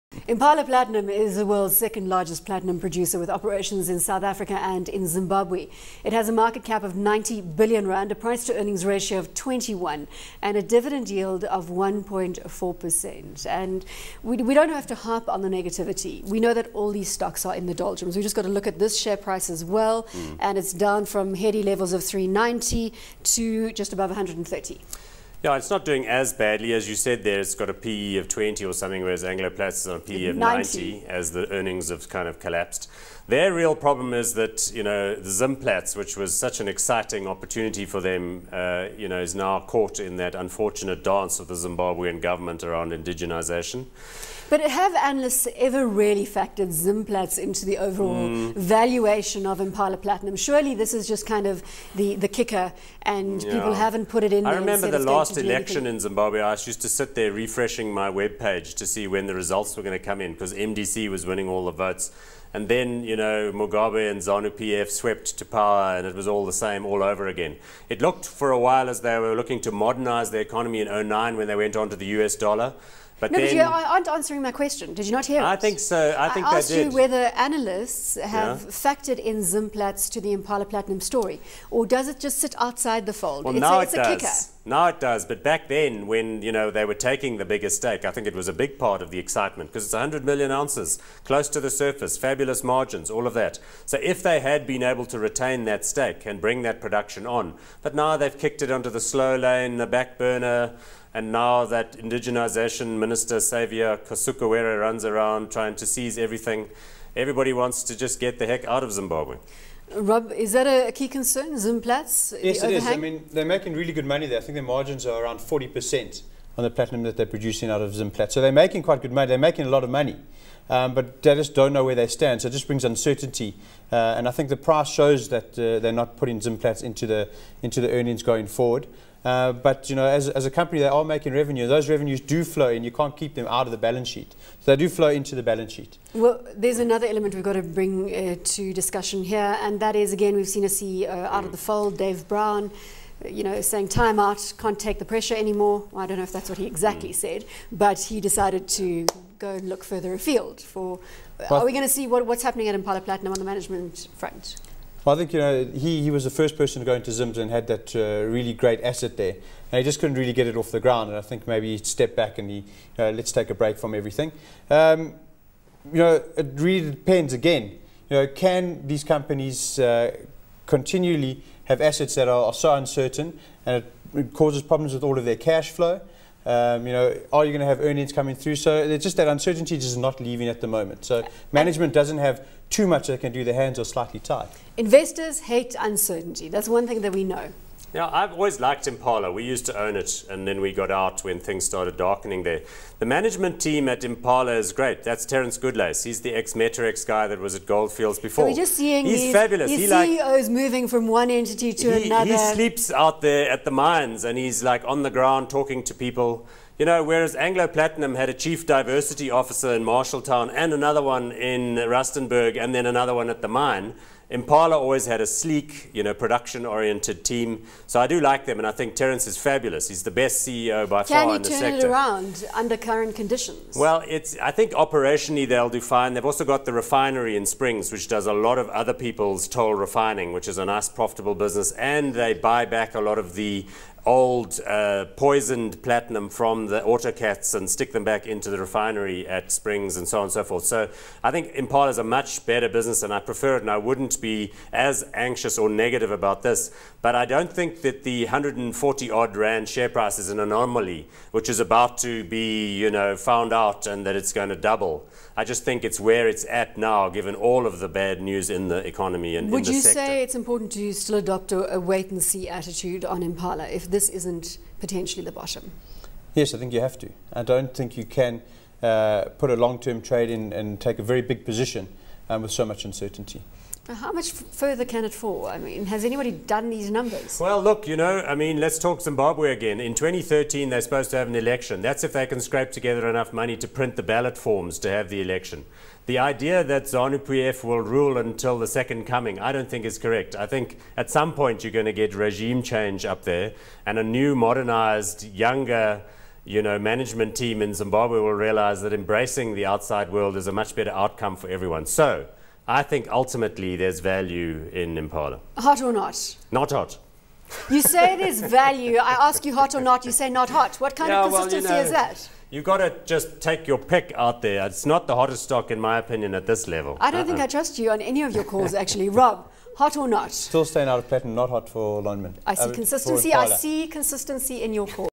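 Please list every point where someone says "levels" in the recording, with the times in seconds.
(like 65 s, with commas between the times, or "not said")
21 s, 316 s.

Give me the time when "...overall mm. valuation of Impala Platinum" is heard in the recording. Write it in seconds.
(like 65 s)
47 s.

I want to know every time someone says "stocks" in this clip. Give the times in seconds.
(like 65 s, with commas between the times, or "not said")
17 s, 315 s.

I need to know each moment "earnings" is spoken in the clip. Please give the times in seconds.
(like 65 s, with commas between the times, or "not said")
8 s, 31 s, 127 s, 177 s.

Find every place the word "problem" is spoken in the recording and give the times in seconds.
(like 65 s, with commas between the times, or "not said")
33 s, 174 s.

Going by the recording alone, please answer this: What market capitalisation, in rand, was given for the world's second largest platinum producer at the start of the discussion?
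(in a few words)
90 billion rand.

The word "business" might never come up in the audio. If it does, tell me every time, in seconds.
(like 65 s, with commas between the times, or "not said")
231 s, 242 s.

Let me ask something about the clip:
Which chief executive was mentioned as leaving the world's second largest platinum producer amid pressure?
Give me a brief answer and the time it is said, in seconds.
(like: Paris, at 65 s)
Dave Brown, at 141 s.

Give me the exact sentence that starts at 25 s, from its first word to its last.
Yeah, it's not doing as badly as you said there.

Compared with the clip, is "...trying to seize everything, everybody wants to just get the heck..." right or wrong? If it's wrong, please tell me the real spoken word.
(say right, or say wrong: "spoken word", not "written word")
right.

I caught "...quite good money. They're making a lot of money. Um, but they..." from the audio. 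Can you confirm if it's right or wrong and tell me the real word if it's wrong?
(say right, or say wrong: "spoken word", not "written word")
right.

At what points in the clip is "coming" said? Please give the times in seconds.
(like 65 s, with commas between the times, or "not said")
178 s, 289 s.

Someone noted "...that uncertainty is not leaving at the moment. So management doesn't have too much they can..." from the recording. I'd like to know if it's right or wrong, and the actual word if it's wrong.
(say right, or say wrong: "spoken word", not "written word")
right.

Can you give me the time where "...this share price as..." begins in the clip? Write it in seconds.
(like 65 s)
18 s.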